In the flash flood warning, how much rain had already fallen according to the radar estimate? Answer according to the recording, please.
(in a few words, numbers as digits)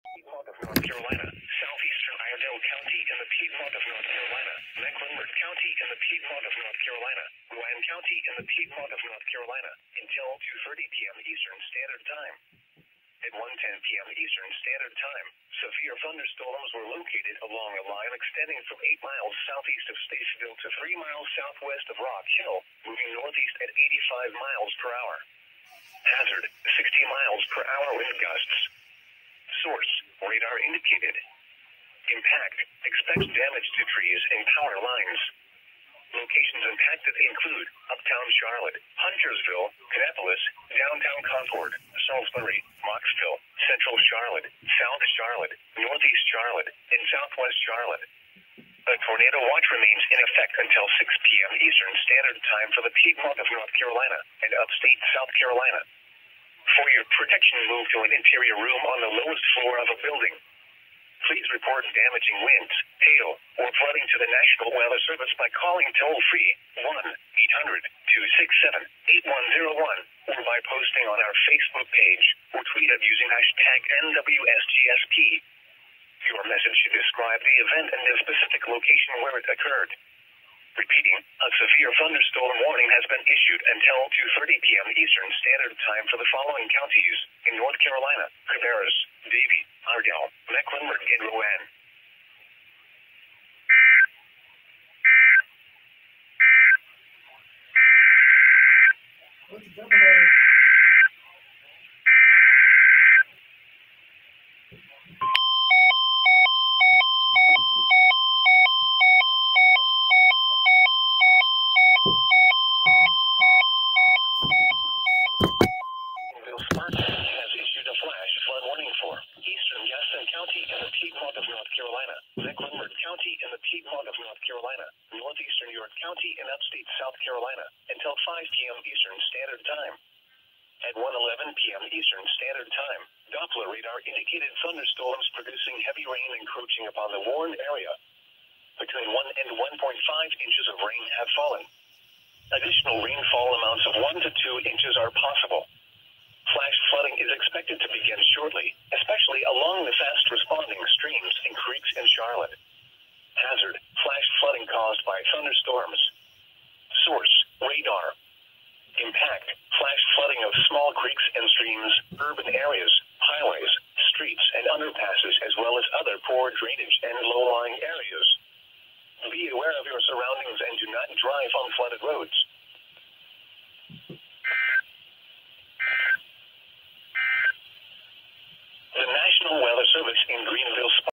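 1 to 1.5 inches.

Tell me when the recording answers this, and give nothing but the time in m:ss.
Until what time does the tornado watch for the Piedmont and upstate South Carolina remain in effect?
0:50.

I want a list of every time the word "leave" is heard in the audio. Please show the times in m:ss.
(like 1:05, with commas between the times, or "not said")
not said.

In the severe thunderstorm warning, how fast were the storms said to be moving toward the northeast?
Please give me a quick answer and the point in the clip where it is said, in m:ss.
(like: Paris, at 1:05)
85 miles per hour, at 0:24.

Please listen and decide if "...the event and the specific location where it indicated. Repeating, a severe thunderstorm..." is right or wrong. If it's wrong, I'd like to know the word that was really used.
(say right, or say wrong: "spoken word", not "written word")
wrong: "occurred", not "indicated".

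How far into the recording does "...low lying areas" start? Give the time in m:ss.
2:47.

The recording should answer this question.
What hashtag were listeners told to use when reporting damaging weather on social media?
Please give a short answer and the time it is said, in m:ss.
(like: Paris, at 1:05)
NWSGSP, at 1:14.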